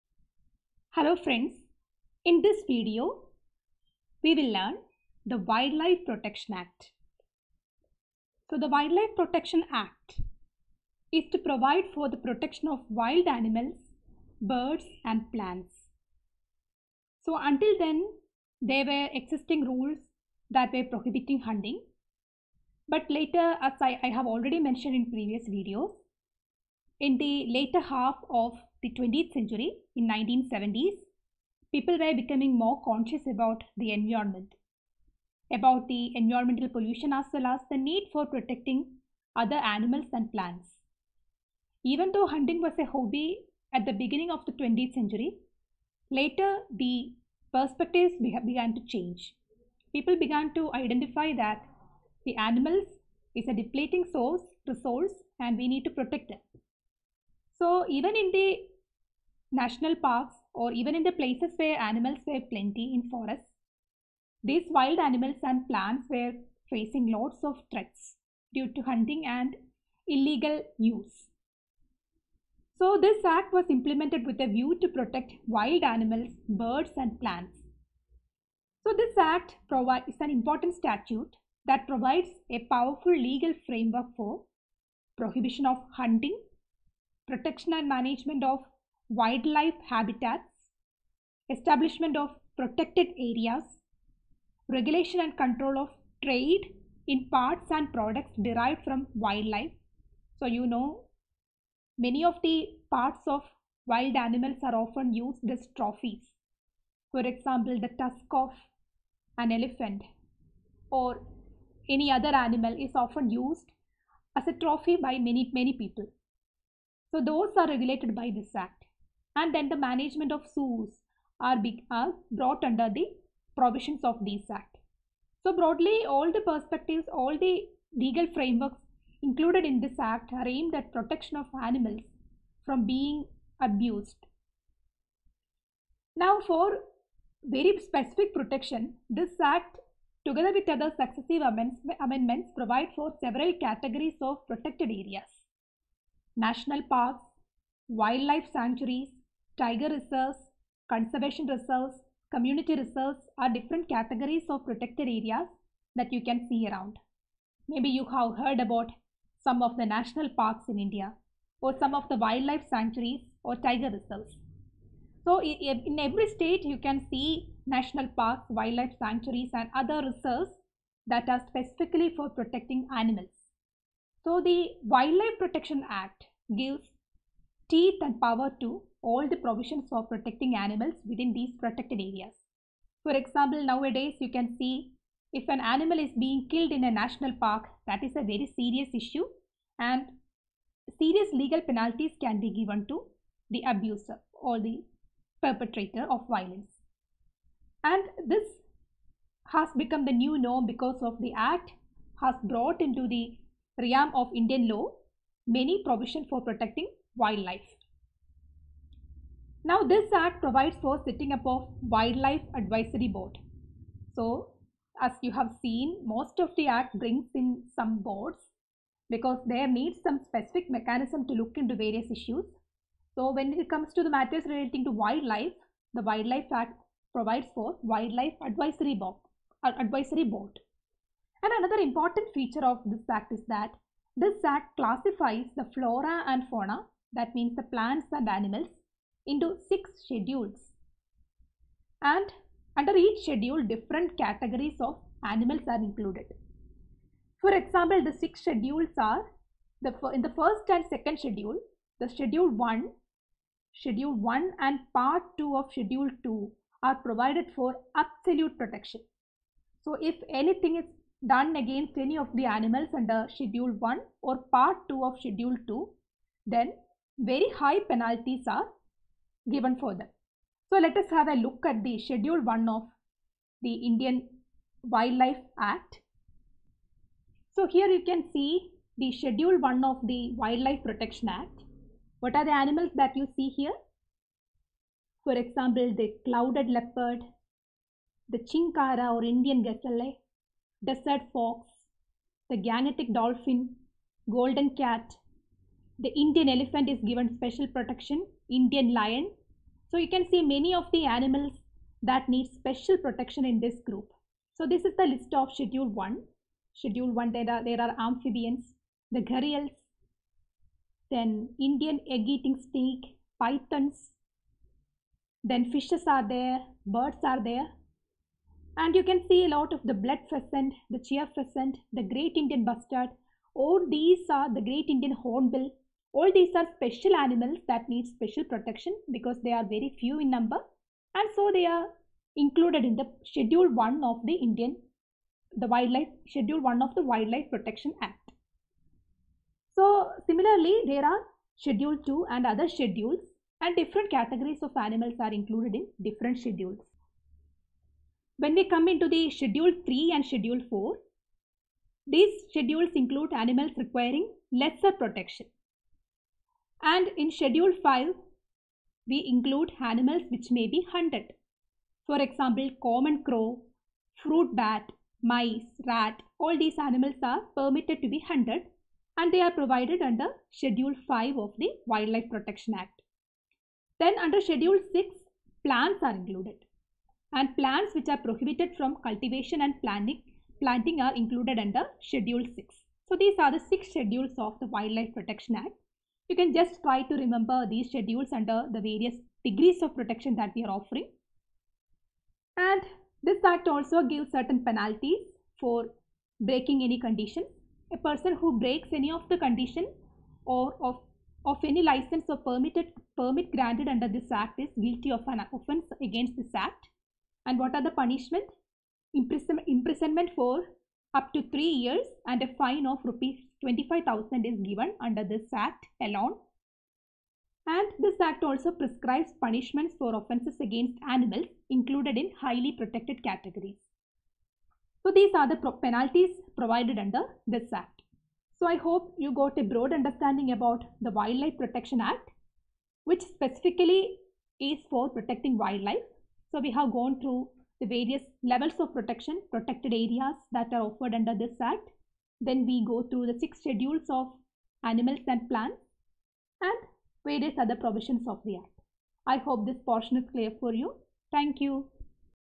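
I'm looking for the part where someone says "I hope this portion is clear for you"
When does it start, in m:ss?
7:29.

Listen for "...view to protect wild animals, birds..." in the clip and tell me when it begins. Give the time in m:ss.
1:14.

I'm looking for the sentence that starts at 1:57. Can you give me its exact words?
So those are regulated by this act.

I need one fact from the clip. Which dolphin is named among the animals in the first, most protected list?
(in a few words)
Gangetic dolphin.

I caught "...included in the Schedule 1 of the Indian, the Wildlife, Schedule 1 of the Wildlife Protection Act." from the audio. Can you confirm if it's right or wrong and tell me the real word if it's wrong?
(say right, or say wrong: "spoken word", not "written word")
right.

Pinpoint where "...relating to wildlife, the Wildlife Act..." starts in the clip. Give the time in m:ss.
3:44.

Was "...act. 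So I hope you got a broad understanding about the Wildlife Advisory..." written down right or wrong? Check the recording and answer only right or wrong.
wrong.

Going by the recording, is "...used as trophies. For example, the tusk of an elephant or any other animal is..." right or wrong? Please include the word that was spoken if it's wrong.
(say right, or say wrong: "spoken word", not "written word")
right.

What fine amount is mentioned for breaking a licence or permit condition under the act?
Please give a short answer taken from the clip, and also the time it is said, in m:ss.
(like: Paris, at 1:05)
Rs 25,000, at 6:53.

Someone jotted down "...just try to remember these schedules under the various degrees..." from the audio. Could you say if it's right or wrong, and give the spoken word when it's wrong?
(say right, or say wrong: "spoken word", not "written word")
right.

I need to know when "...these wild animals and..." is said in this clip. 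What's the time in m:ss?
1:04.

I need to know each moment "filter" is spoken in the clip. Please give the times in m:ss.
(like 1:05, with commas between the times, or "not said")
not said.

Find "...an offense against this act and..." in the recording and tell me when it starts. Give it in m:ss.
6:45.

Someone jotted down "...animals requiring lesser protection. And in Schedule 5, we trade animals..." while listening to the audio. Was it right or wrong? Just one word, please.
wrong.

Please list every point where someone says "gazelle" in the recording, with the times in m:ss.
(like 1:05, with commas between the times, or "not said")
4:49.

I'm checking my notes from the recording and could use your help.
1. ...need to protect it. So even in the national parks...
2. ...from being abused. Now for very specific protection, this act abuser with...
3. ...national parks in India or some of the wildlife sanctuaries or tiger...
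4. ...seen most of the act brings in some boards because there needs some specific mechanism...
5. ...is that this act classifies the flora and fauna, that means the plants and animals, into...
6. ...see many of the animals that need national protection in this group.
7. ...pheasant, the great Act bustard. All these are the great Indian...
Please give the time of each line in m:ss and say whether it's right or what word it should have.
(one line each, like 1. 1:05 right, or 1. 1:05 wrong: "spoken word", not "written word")
1. 0:55 right
2. 2:12 wrong: "together", not "abuser"
3. 2:39 right
4. 3:35 right
5. 3:53 right
6. 5:00 wrong: "special", not "national"
7. 5:21 wrong: "Indian", not "Act".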